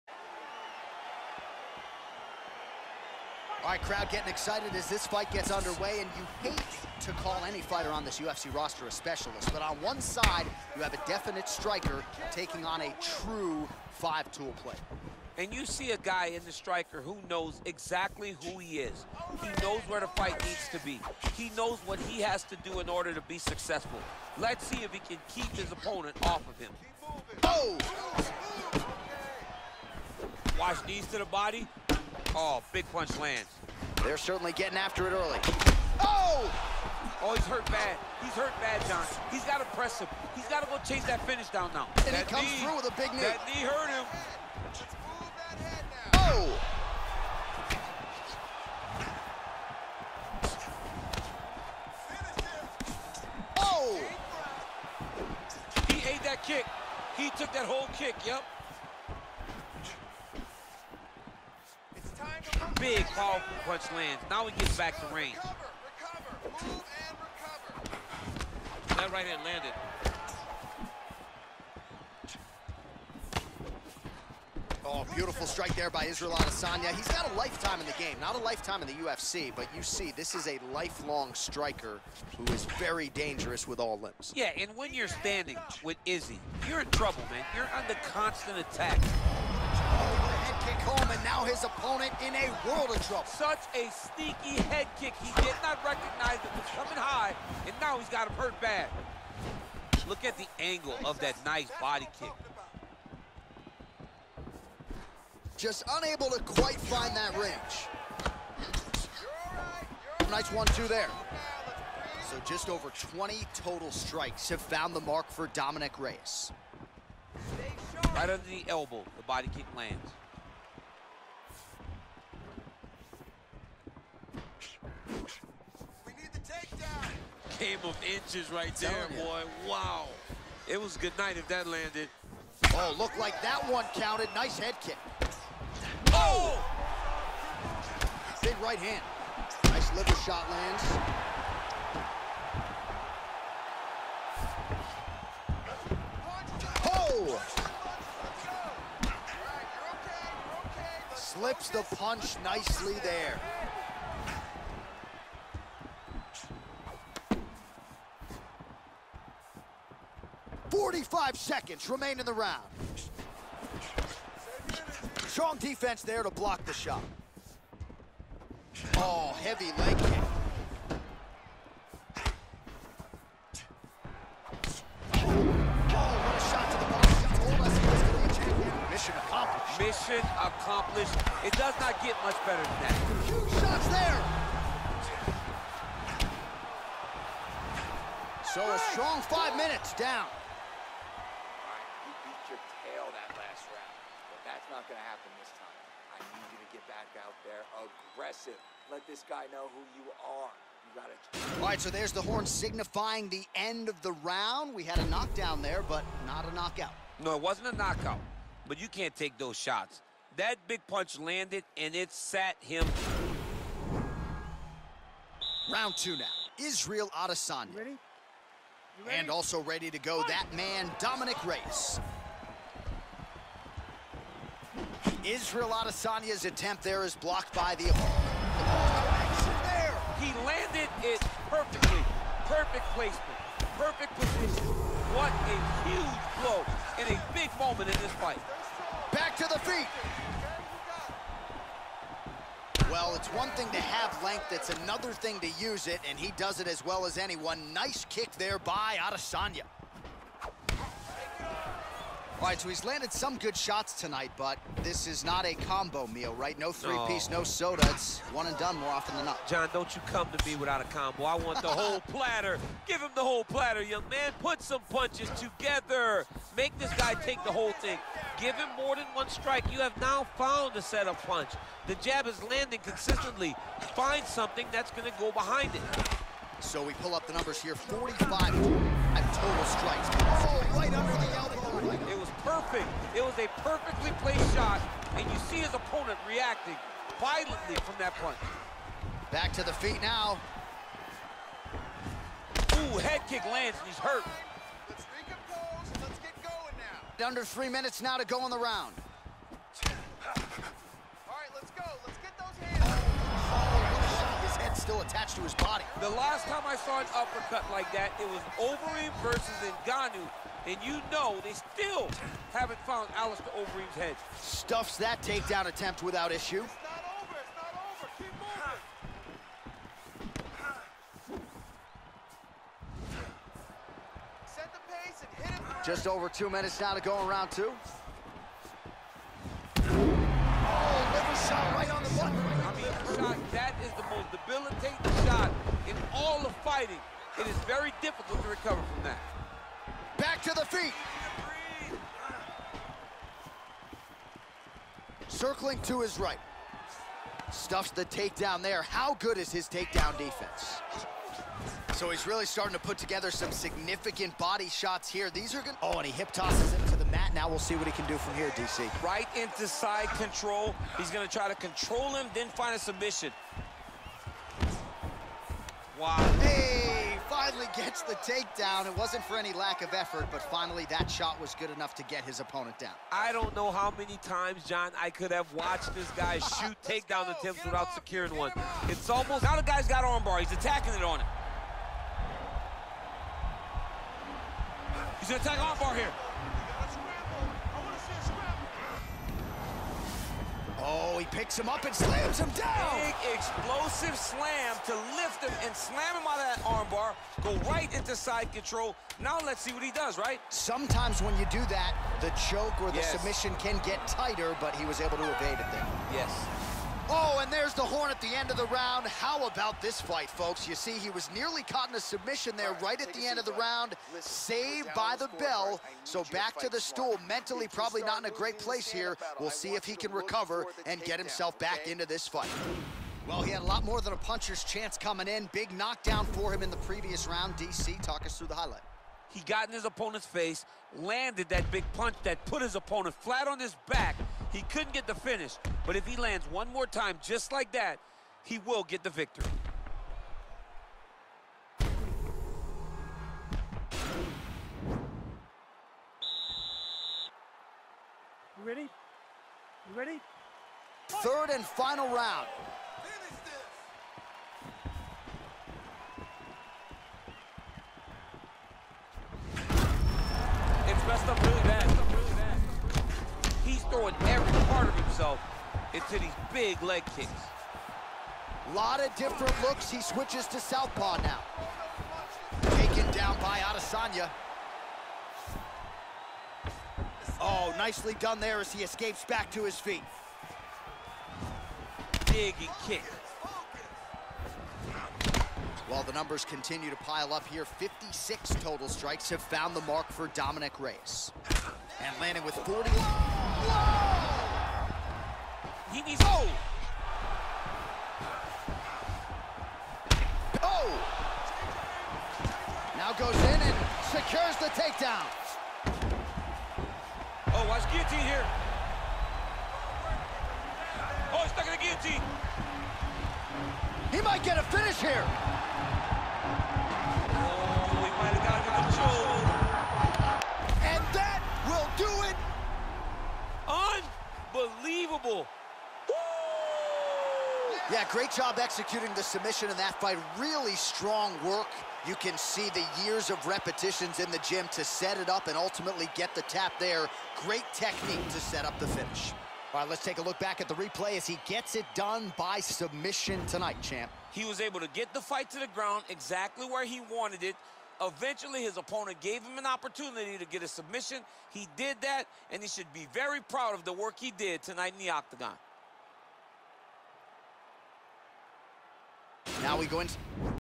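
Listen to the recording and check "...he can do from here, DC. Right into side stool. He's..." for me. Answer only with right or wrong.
wrong.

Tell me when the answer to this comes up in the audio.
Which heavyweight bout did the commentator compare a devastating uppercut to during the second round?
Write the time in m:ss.
5:08.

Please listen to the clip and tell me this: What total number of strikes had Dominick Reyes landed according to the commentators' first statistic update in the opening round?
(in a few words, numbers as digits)
over 20.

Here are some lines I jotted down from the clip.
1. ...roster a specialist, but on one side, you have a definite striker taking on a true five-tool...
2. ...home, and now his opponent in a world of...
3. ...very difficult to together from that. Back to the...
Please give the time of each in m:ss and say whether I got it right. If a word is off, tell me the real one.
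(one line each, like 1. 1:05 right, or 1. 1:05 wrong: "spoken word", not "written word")
1. 0:08 right
2. 1:30 right
3. 5:37 wrong: "recover", not "together".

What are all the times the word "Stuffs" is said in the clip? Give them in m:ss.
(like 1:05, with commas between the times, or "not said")
5:14, 5:47.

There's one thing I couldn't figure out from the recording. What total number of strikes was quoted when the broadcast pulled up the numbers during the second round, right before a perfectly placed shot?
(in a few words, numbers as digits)
45.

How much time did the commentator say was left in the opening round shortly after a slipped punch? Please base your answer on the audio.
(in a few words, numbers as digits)
45 seconds.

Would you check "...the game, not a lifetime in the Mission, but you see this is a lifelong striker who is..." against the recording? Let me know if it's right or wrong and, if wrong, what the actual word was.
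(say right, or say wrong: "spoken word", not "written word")
wrong: "UFC", not "Mission".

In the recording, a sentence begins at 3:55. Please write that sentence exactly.
What a huge blow in a big moment in this fight.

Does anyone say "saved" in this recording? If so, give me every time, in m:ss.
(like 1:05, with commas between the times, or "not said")
6:54.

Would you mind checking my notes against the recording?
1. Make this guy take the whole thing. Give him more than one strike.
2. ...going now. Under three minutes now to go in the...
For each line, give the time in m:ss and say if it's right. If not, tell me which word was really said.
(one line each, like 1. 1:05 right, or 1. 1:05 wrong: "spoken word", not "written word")
1. 4:26 right
2. 4:56 right.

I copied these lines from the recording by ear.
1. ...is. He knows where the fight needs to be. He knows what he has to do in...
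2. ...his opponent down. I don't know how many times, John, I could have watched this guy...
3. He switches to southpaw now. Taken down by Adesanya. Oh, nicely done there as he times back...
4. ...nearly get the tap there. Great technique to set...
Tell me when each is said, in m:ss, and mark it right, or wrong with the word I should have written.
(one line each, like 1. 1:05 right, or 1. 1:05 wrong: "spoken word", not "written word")
1. 0:18 right
2. 6:12 right
3. 7:49 wrong: "escapes", not "times"
4. 8:55 wrong: "ultimately", not "nearly".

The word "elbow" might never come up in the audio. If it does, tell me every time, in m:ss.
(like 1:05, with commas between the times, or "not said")
1:58.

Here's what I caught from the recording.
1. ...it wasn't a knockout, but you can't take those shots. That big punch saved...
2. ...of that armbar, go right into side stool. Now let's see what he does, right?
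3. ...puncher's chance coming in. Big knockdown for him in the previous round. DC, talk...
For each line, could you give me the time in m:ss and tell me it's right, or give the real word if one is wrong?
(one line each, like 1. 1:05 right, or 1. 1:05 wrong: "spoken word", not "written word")
1. 3:27 wrong: "landed", not "saved"
2. 6:36 wrong: "control", not "stool"
3. 7:04 right.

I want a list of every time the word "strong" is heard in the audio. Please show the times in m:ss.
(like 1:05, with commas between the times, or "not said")
2:45, 3:08, 8:50.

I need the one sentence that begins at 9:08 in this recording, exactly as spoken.
Eventually, his opponent gave him an opportunity to get a submission.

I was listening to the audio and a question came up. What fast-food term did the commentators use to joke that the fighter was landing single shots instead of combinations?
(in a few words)
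Combo meal.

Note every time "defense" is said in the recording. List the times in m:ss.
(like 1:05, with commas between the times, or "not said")
2:45, 5:50.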